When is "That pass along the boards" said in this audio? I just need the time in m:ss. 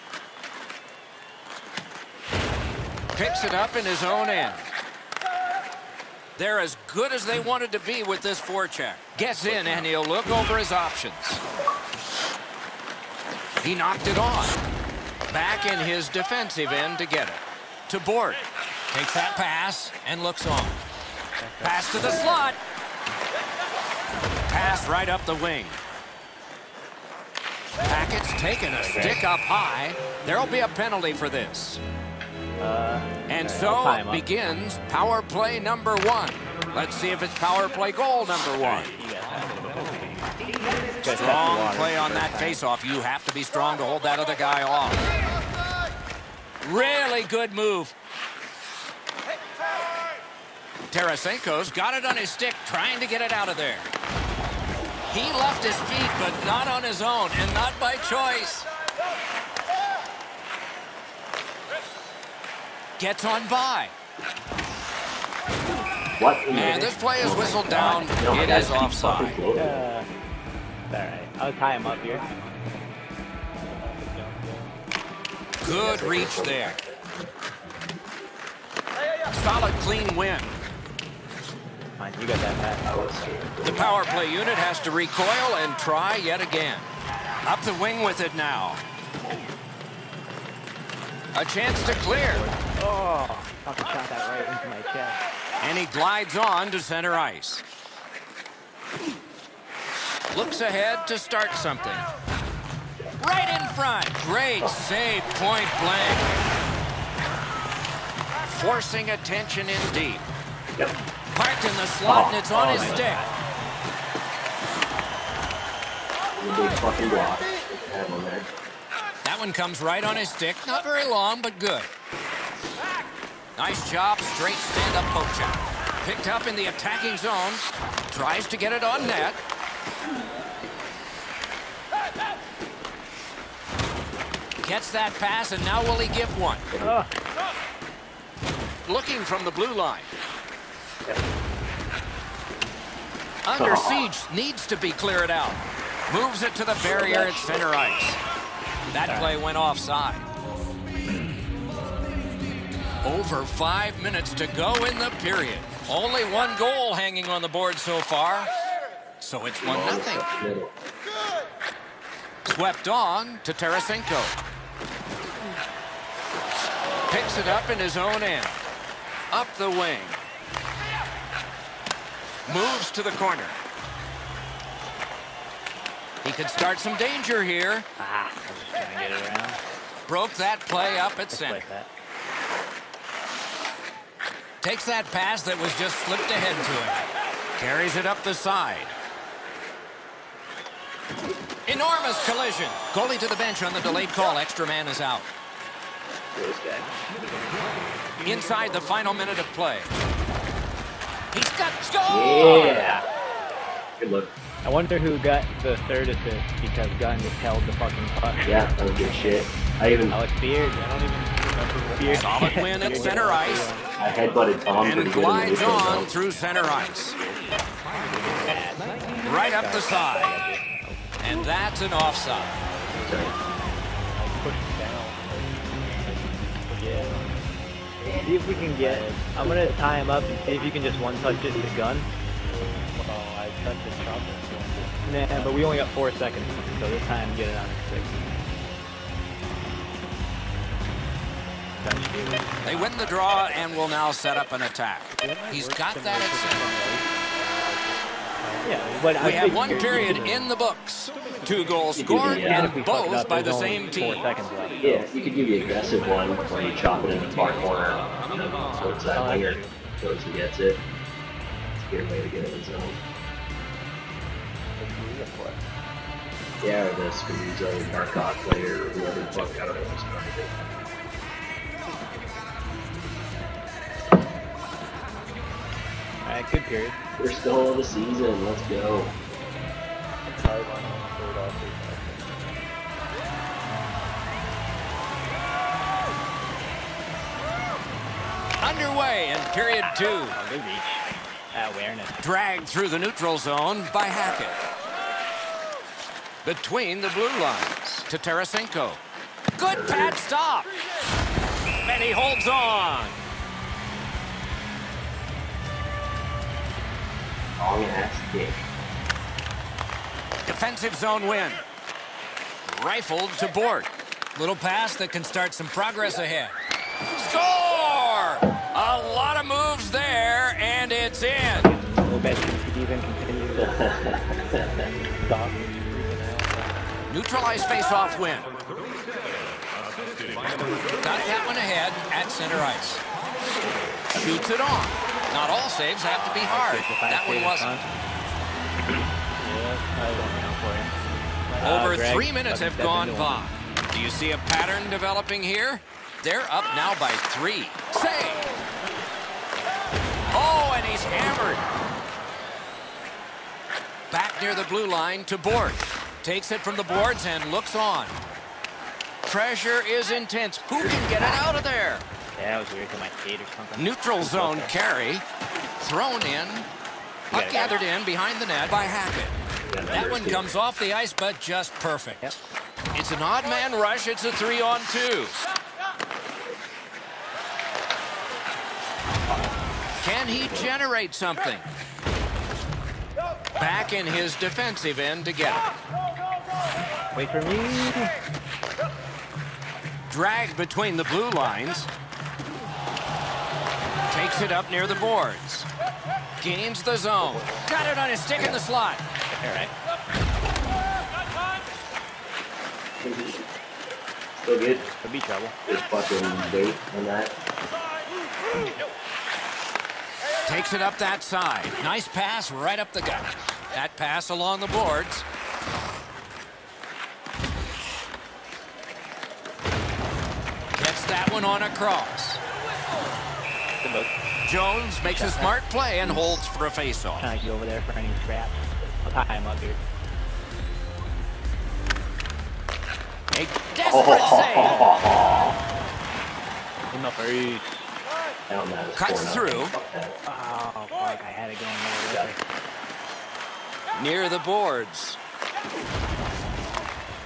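6:53.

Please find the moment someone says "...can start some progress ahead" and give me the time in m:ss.
5:15.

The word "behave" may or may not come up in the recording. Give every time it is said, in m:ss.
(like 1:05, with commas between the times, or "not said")
not said.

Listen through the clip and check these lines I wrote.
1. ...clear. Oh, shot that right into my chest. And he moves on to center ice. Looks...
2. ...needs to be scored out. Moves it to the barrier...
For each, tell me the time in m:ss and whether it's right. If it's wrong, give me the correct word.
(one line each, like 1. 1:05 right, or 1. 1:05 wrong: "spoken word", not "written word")
1. 1:31 wrong: "glides", not "moves"
2. 2:24 wrong: "cleared", not "scored".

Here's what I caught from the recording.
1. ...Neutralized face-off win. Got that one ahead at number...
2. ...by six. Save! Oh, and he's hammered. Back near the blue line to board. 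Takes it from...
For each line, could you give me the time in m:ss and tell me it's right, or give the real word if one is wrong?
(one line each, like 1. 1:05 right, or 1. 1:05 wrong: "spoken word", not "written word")
1. 5:27 wrong: "center", not "number"
2. 5:46 wrong: "three", not "six".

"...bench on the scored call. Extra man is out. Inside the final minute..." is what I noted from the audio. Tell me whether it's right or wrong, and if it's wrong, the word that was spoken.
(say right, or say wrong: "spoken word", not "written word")
wrong: "delayed", not "scored".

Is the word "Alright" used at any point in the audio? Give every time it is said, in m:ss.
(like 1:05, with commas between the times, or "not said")
4:36, 6:39.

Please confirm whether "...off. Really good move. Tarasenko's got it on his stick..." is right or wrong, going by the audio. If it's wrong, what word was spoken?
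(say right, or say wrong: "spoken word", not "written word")
right.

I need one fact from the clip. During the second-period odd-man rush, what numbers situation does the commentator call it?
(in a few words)
3 on 2.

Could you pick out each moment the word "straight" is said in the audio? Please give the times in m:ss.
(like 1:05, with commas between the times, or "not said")
2:04.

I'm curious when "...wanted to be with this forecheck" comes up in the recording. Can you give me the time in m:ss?
0:07.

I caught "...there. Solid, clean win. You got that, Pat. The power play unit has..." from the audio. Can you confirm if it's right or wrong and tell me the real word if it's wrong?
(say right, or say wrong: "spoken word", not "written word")
right.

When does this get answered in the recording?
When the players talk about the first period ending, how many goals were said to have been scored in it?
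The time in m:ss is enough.
4:11.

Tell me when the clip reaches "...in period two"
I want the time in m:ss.
4:49.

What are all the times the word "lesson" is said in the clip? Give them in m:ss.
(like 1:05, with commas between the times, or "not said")
not said.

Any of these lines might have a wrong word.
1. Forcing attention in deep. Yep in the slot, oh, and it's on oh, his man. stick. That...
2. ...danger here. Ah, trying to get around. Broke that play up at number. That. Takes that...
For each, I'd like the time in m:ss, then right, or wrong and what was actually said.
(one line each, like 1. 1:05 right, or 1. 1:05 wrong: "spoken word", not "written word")
1. 1:48 right
2. 2:56 wrong: "center", not "number".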